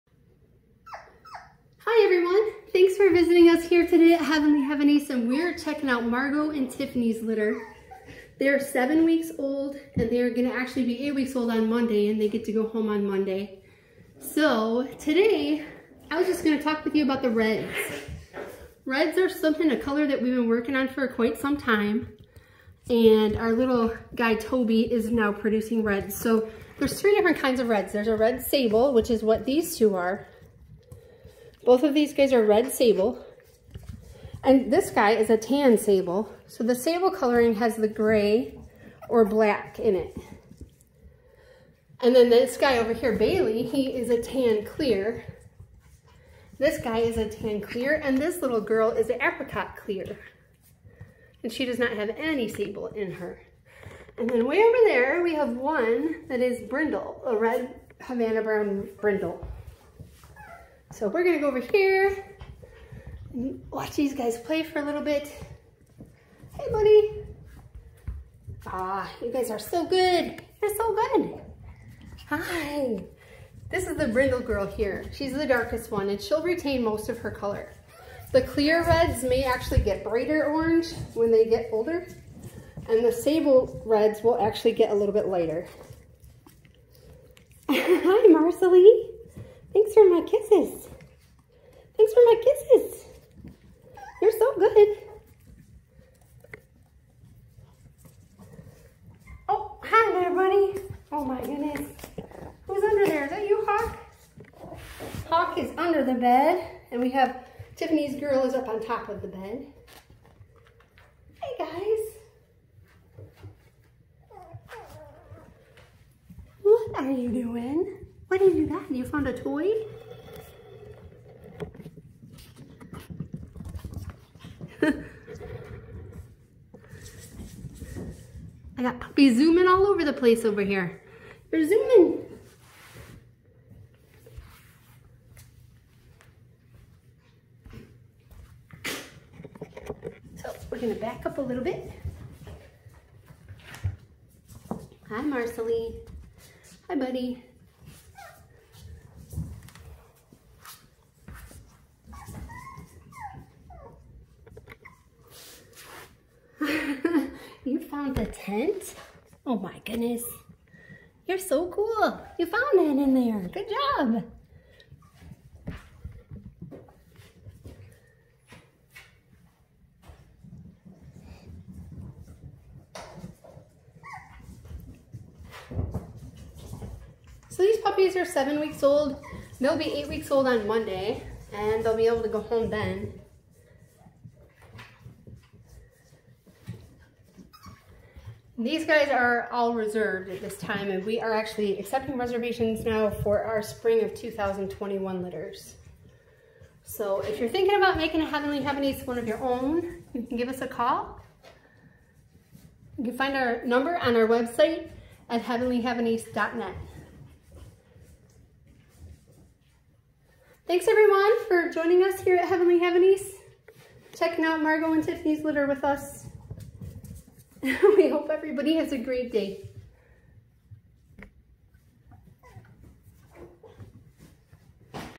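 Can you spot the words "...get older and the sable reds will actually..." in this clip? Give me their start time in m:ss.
1:21.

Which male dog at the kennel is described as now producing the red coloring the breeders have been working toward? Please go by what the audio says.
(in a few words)
Toby.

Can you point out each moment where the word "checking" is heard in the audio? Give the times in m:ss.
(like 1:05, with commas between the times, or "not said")
0:05, 3:34.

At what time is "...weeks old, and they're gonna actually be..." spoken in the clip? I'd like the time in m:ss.
0:09.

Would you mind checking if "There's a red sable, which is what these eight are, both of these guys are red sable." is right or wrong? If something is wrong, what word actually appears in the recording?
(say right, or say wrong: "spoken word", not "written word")
wrong: "two", not "eight".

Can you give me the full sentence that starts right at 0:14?
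So today, I was just gonna talk with you about the reds.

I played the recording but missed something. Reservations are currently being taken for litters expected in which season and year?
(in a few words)
spring of 2021.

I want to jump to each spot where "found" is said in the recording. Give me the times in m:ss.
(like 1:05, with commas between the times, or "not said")
1:59, 2:38, 2:42.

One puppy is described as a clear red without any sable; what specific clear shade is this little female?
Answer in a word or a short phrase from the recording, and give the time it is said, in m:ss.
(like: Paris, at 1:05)
apricot clear, at 0:49.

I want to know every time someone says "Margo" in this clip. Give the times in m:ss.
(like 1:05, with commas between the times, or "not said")
0:06, 3:34.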